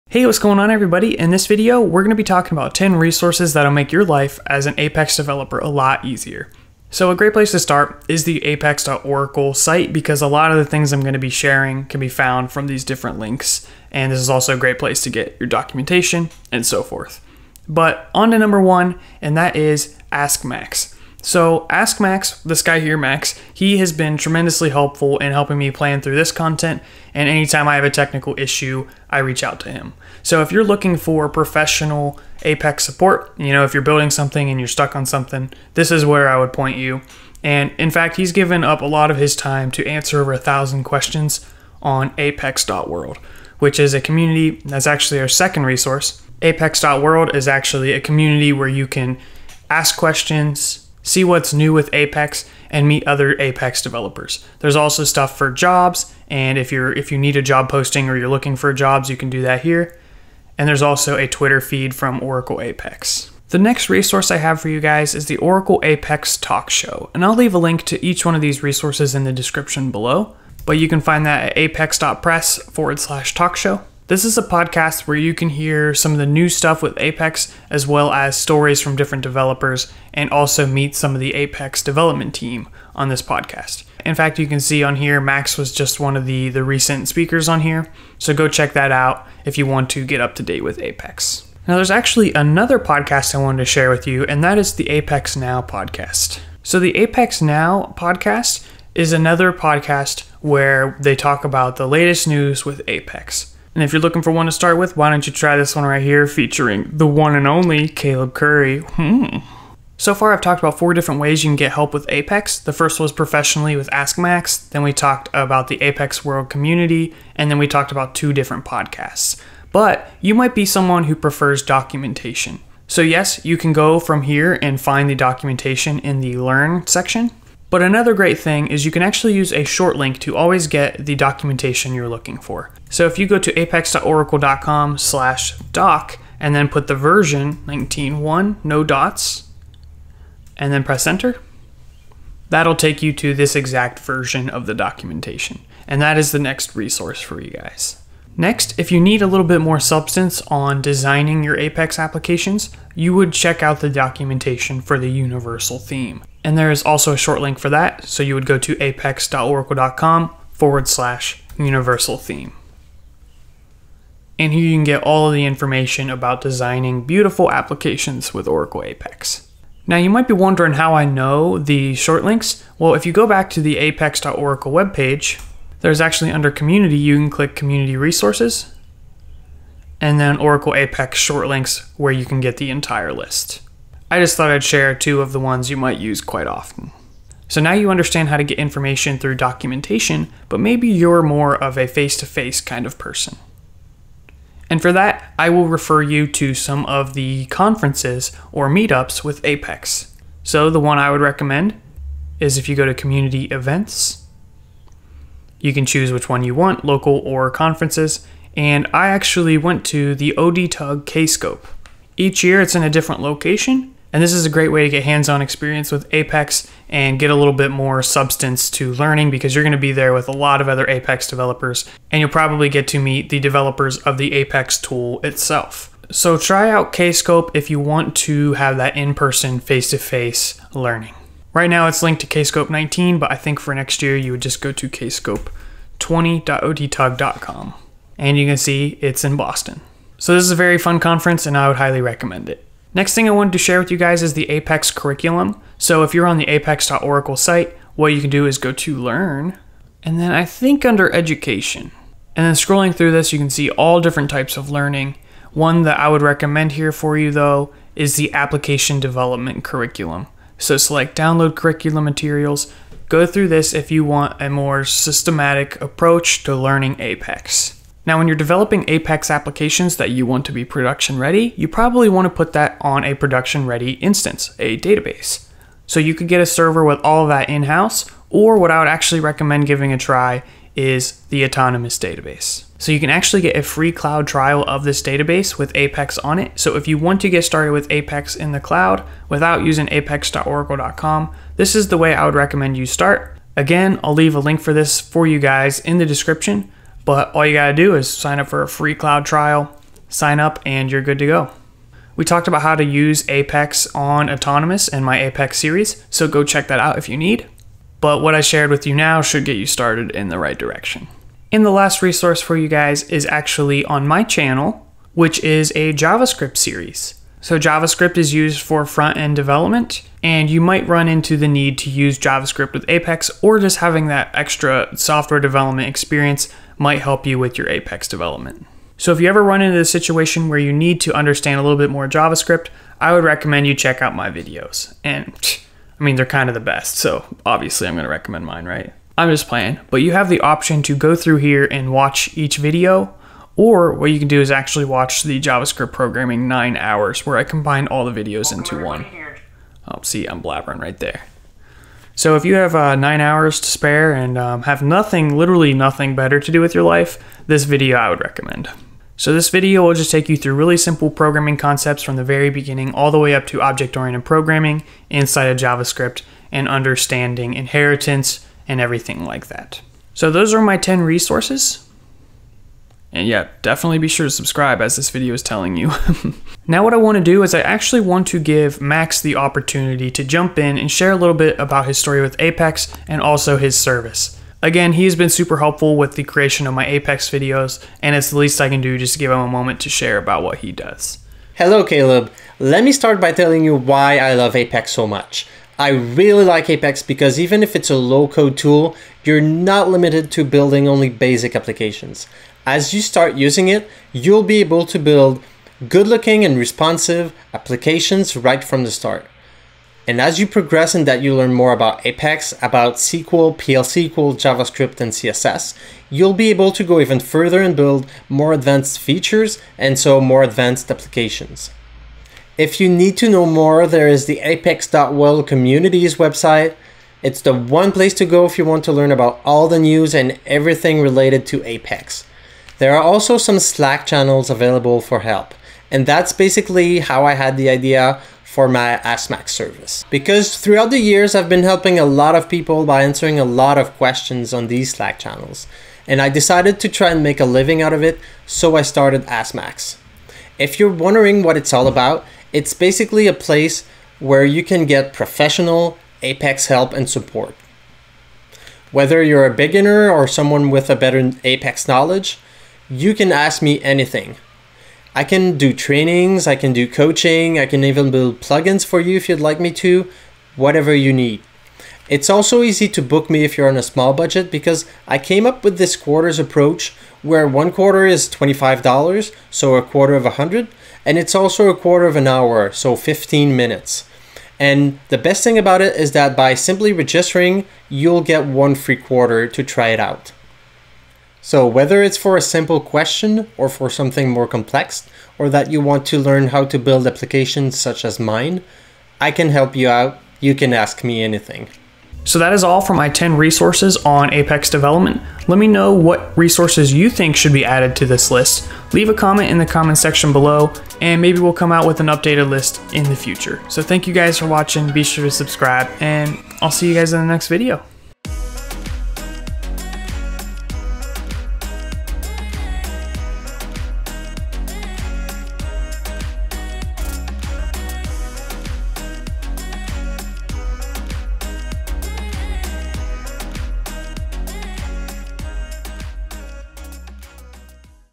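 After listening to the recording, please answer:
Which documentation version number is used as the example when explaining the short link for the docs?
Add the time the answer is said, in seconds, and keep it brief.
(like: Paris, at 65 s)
19.1, at 137 s.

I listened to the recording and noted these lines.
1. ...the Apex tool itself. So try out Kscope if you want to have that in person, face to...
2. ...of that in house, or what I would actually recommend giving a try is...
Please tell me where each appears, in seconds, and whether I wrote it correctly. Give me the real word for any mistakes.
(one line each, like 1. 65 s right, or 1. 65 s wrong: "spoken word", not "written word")
1. 224 s right
2. 277 s right.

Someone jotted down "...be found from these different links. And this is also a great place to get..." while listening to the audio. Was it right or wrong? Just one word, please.
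right.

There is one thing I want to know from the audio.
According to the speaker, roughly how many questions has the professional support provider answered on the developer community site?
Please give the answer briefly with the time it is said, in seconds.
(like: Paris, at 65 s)
over 1,000, at 40 s.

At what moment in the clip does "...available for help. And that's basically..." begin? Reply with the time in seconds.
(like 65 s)
434 s.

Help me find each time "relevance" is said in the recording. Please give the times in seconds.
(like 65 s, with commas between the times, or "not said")
not said.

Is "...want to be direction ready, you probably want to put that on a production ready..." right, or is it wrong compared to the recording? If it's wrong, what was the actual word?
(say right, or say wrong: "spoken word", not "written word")
wrong: "production", not "direction".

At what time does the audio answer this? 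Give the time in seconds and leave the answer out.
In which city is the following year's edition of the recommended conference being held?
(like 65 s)
239 s.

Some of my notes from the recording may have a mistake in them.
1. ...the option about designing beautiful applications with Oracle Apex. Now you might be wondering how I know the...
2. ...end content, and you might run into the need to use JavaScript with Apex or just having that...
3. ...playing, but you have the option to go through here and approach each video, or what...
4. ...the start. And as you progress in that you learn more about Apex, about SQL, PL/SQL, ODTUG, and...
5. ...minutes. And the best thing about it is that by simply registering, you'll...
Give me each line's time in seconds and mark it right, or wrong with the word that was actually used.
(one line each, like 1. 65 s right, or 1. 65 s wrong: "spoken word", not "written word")
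1. 165 s wrong: "information", not "option"
2. 319 s wrong: "development", not "content"
3. 339 s wrong: "watch", not "approach"
4. 408 s wrong: "JavaScript", not "ODTUG"
5. 483 s right.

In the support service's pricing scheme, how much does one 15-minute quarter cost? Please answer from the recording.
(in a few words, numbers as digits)
$25.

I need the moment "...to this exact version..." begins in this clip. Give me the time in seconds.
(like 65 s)
143 s.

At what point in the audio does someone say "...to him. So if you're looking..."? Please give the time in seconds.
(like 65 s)
29 s.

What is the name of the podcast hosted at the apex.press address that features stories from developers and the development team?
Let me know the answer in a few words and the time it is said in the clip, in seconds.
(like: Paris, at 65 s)
Oracle Apex Talk Show, at 65 s.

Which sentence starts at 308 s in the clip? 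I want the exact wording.
But what I shared with you now should get you started in the right direction.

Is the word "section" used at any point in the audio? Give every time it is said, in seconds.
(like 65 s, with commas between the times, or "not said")
126 s, 509 s.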